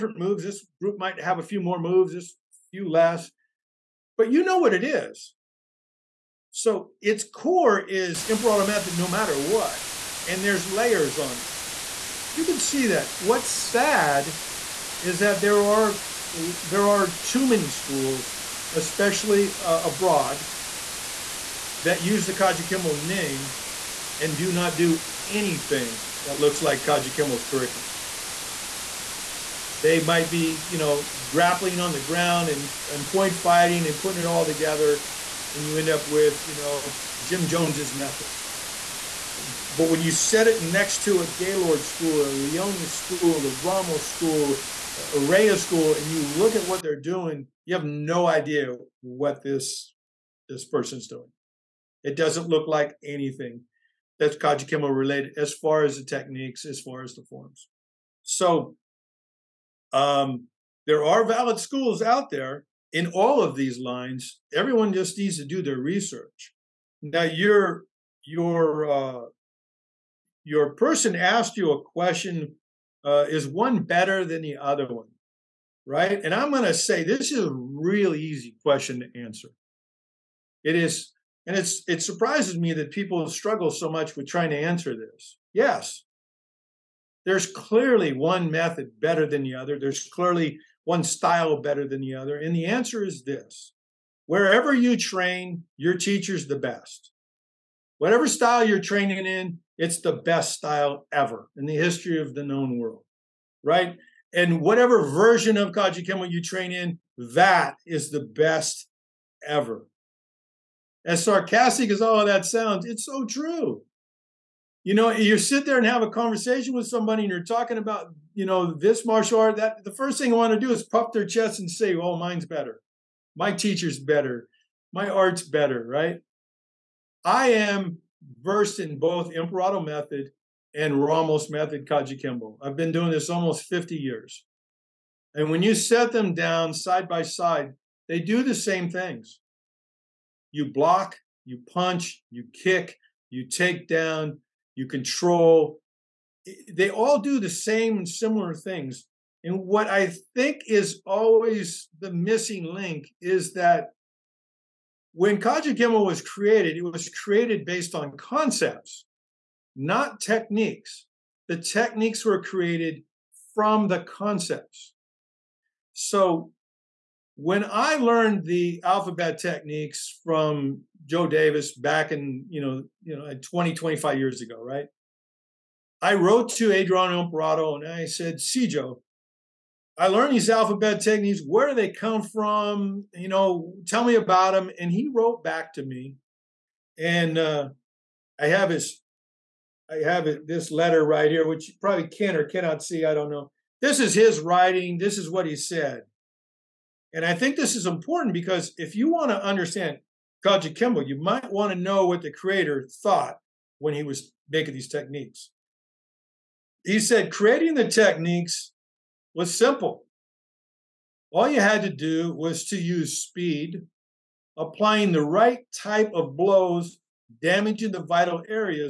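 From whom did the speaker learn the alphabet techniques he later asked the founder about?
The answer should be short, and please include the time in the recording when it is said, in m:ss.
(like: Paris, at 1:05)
Joe Davis, at 2:51.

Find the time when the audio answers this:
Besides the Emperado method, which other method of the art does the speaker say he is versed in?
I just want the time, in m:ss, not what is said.
2:11.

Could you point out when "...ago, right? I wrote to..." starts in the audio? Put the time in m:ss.
2:54.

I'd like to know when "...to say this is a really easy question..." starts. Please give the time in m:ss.
1:16.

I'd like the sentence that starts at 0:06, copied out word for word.
So its core is Emperado method no matter what, and there's layers on it.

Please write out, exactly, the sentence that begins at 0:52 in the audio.
It doesn't look like anything that's Kajukenbo related as far as the techniques, as far as the forms.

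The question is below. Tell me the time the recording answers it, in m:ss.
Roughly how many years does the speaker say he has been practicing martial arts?
2:13.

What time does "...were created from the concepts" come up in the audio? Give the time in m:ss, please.
2:42.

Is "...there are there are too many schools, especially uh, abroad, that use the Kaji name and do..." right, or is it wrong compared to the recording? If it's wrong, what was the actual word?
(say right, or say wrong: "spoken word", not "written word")
right.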